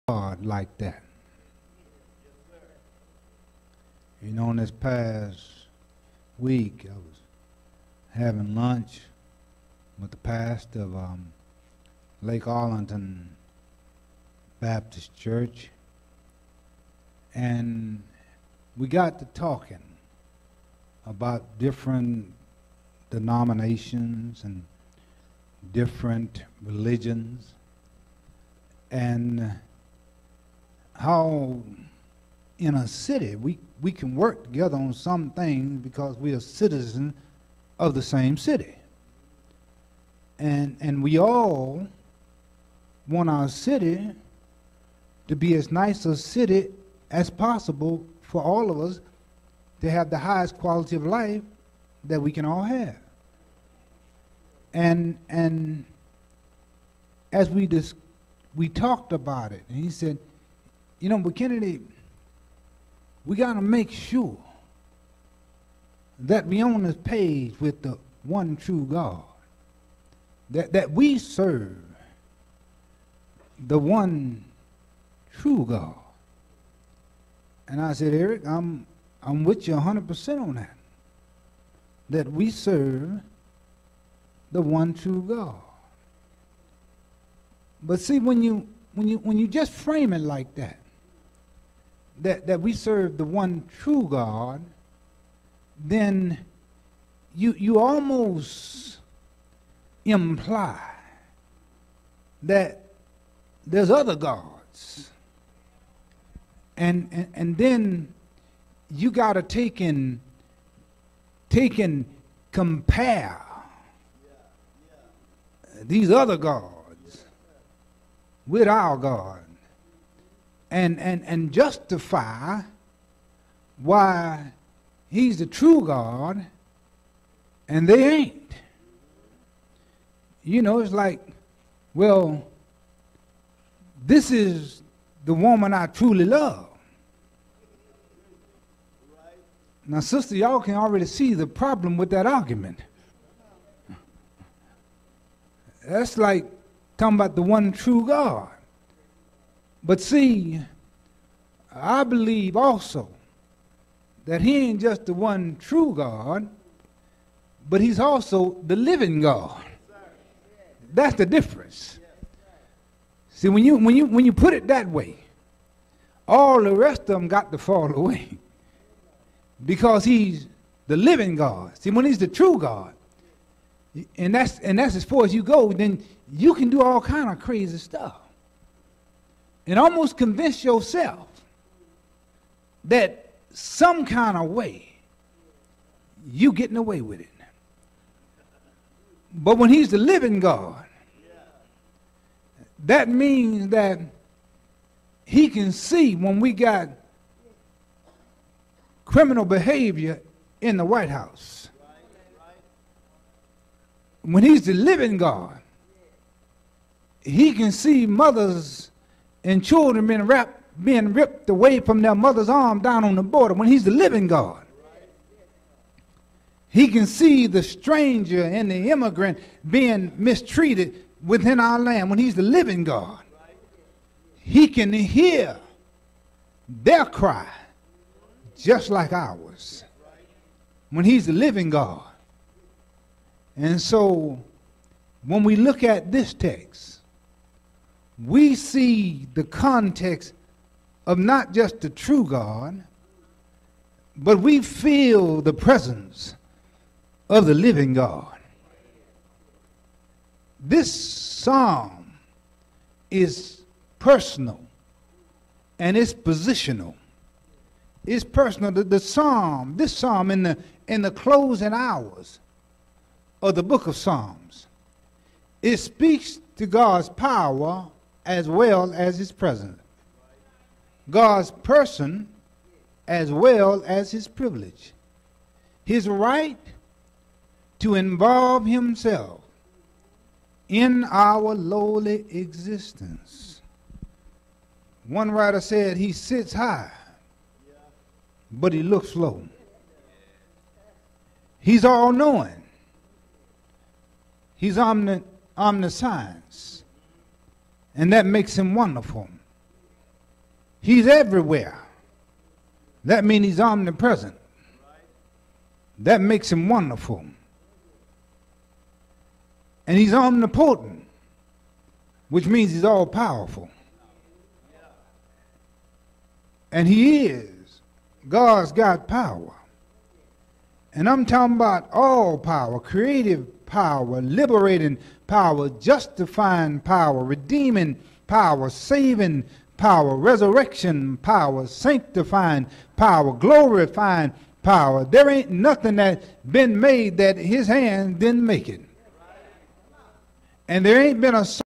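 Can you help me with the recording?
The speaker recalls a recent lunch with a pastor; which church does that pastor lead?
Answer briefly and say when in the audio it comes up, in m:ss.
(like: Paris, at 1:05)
Lake Arlington Baptist Church, at 0:12.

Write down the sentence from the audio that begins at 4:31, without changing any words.
God's person as well as his privilege.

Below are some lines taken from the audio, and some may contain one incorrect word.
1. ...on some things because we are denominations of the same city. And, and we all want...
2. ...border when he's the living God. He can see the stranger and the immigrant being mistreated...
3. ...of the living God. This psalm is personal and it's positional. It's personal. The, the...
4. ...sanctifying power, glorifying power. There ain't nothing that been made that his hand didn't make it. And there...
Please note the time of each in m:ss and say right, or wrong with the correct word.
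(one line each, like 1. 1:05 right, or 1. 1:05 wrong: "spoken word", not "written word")
1. 0:34 wrong: "citizens", not "denominations"
2. 3:33 right
3. 4:07 right
4. 5:31 right.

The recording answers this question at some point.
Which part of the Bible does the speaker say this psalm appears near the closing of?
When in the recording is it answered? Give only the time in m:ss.
4:23.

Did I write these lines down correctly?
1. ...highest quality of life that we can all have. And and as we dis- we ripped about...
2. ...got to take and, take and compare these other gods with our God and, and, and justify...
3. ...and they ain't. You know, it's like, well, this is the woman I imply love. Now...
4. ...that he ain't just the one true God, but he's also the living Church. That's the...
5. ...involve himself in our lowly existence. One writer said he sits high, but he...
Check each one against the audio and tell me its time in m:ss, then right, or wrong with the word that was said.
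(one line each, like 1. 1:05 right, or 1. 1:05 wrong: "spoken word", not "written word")
1. 0:50 wrong: "talked", not "ripped"
2. 1:49 right
3. 2:07 wrong: "truly", not "imply"
4. 2:34 wrong: "God", not "Church"
5. 4:37 right.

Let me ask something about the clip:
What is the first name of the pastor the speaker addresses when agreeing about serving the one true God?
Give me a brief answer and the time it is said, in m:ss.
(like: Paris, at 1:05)
Eric, at 1:18.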